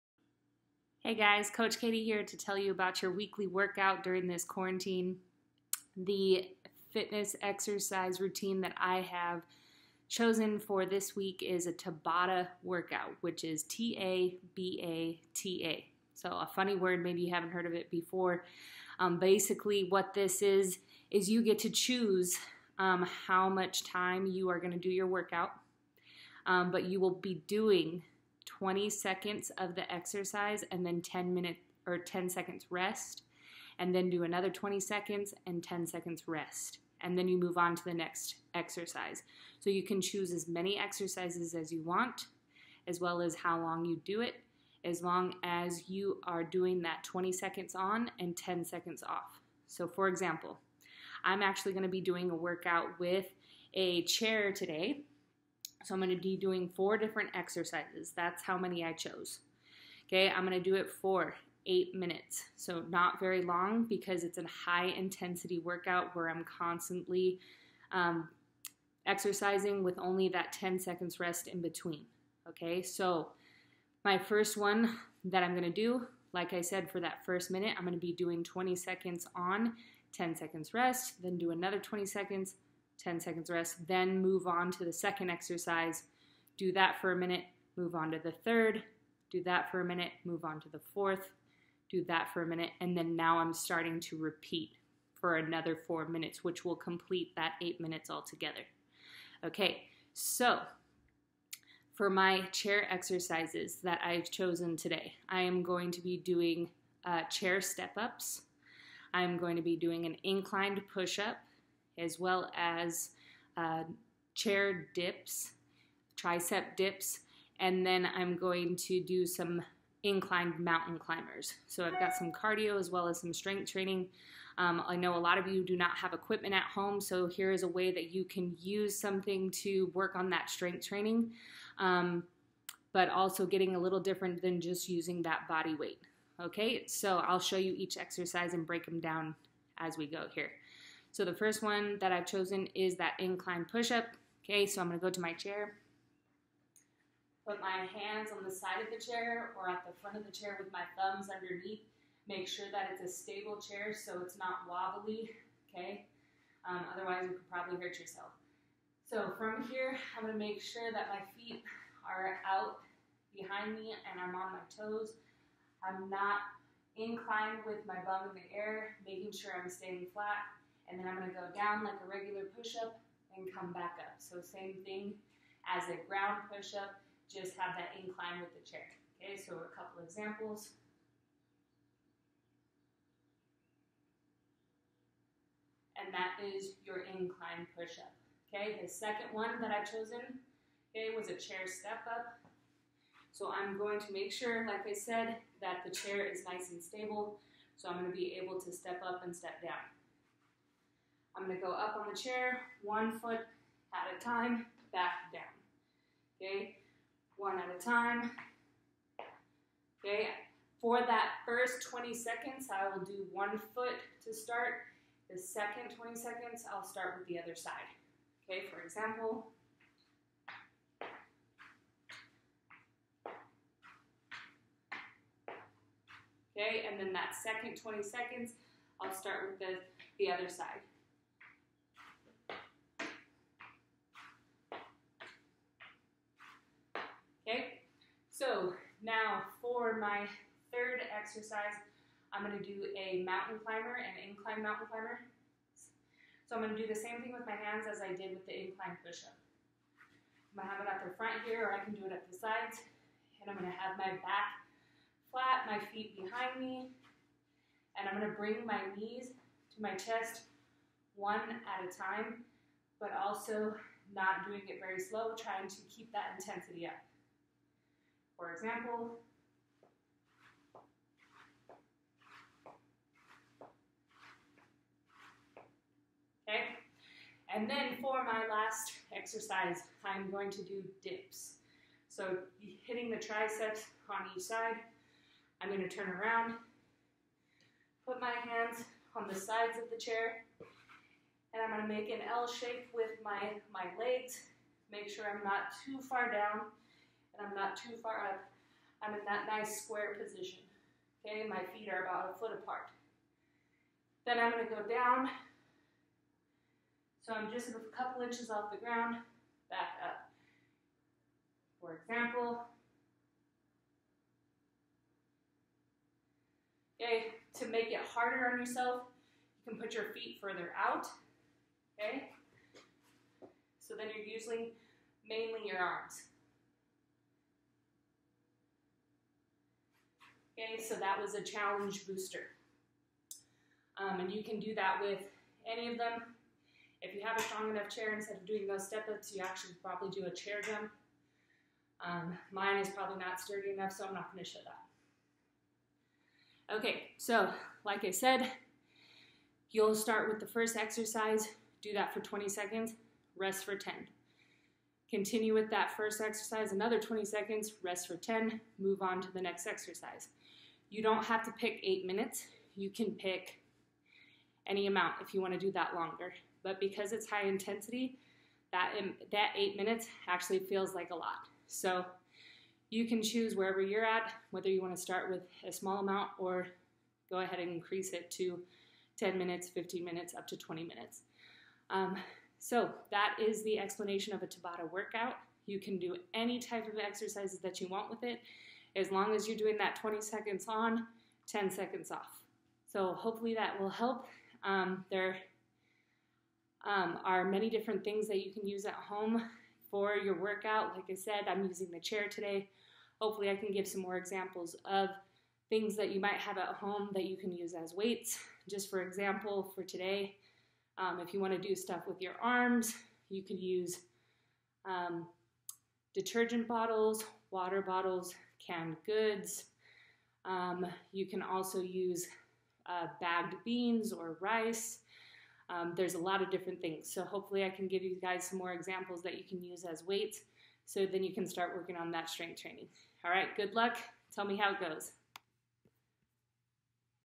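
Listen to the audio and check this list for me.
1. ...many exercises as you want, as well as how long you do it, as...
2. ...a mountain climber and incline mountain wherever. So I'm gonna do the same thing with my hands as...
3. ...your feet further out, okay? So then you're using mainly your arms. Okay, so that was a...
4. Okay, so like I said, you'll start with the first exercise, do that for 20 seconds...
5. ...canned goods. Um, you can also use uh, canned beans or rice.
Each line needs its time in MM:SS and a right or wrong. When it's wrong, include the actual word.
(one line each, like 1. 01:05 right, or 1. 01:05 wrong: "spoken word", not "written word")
1. 00:40 right
2. 04:02 wrong: "climber", not "wherever"
3. 05:19 right
4. 05:46 right
5. 06:58 wrong: "bagged", not "canned".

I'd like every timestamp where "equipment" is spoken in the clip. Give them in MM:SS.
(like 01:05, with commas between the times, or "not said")
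02:06.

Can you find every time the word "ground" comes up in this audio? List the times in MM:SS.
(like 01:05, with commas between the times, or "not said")
02:56, 05:08.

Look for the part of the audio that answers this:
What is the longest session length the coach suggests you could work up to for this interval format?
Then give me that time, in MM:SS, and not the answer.
06:20.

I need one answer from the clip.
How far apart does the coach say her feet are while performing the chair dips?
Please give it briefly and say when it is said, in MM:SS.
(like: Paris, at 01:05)
About a foot, at 05:02.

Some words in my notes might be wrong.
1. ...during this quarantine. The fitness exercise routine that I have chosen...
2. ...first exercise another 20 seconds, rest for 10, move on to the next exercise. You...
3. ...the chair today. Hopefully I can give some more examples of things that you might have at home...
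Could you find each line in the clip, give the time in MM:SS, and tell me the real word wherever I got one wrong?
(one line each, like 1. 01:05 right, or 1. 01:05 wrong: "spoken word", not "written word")
1. 00:04 right
2. 05:55 right
3. 06:41 right.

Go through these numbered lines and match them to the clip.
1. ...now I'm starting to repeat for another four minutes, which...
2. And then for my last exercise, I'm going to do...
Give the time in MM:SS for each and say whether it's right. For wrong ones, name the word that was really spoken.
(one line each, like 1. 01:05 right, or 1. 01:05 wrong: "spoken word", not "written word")
1. 01:33 right
2. 04:37 right.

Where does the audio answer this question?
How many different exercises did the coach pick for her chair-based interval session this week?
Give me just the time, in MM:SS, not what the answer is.
00:56.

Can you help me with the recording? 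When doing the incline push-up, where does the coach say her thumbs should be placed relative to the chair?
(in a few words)
Underneath.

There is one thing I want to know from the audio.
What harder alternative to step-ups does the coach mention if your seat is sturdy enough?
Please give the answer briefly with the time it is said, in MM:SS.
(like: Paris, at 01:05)
Chair jump, at 05:40.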